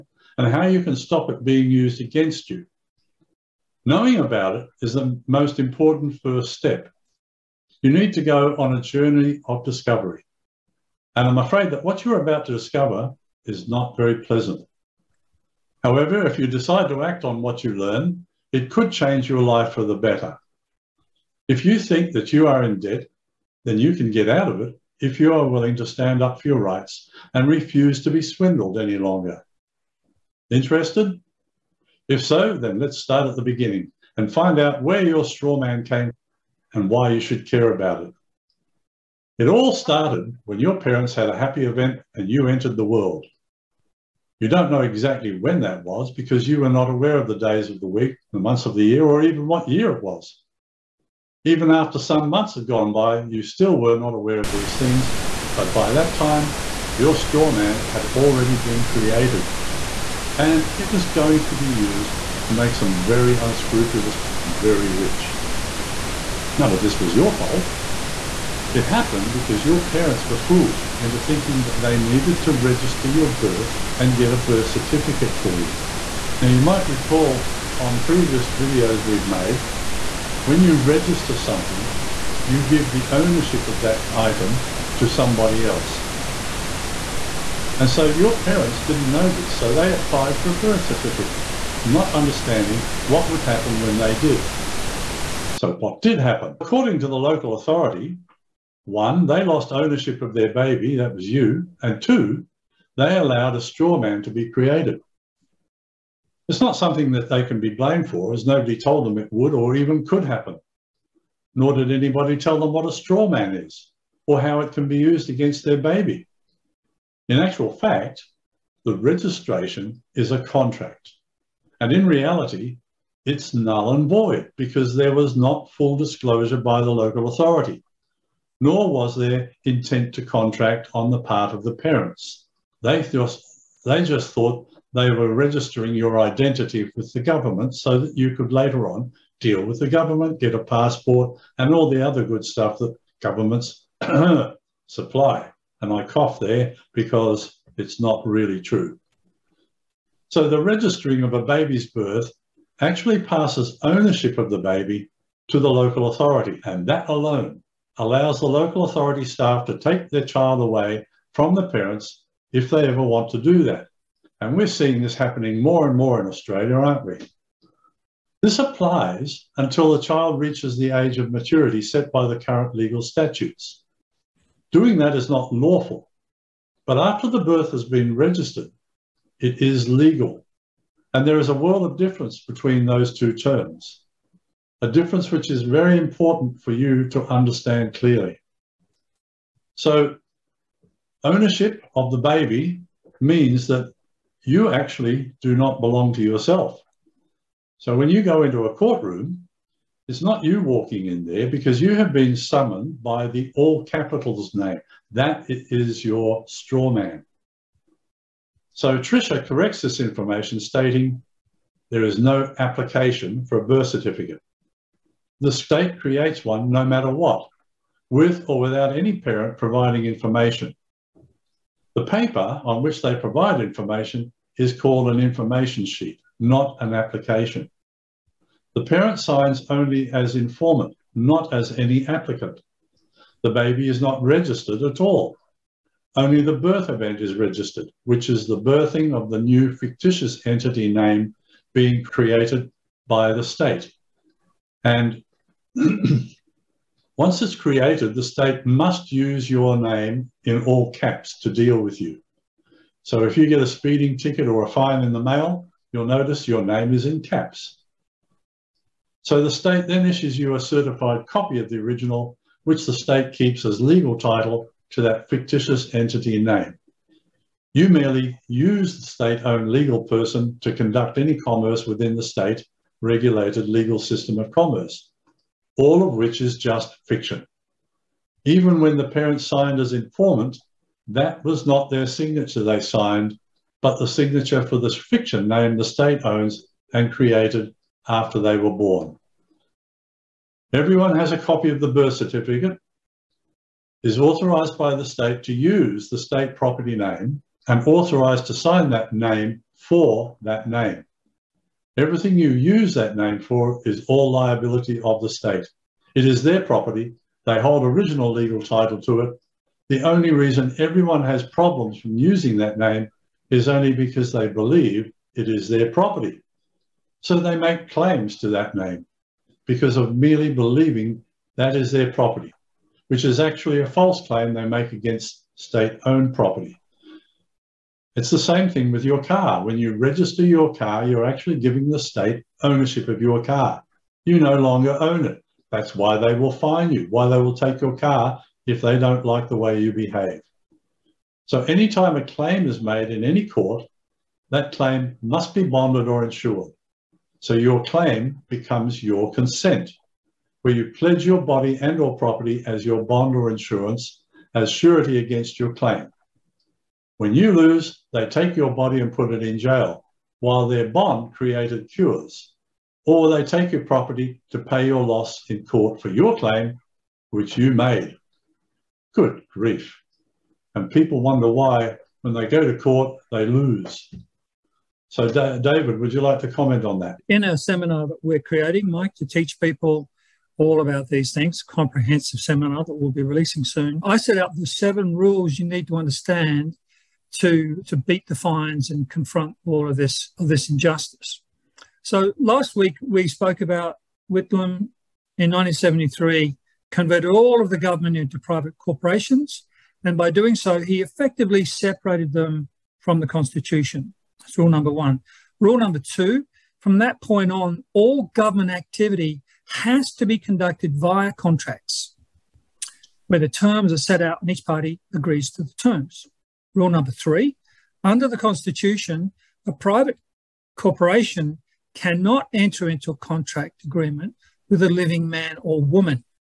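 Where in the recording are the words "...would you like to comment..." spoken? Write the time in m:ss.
6:15.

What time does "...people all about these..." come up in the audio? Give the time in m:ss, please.
6:19.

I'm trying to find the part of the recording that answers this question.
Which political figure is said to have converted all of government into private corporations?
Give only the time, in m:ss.
6:34.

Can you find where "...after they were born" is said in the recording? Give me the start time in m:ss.
4:48.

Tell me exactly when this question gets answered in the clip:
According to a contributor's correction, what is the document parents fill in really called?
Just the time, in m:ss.
3:45.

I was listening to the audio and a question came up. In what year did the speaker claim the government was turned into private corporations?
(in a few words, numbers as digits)
1973.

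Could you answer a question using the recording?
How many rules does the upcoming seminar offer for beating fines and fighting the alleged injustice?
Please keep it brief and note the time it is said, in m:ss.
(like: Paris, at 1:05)
7, at 6:24.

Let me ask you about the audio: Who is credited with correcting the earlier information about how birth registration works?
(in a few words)
Tricia.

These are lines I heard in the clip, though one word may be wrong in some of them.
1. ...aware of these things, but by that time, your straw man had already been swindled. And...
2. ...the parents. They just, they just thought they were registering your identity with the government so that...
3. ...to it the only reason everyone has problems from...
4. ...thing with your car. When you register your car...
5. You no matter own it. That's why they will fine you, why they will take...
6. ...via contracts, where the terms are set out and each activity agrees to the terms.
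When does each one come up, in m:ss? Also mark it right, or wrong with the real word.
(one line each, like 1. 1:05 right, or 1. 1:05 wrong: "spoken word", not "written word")
1. 0:54 wrong: "created", not "swindled"
2. 2:11 right
3. 5:09 right
4. 5:28 right
5. 5:34 wrong: "longer", not "matter"
6. 6:50 wrong: "party", not "activity".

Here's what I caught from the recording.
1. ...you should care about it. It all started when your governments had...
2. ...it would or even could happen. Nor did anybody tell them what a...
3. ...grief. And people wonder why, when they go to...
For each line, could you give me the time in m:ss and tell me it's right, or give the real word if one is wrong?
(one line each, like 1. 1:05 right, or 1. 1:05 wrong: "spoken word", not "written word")
1. 0:37 wrong: "parents", not "governments"
2. 1:49 right
3. 6:09 right.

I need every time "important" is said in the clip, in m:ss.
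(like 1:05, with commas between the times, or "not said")
0:05, 3:05.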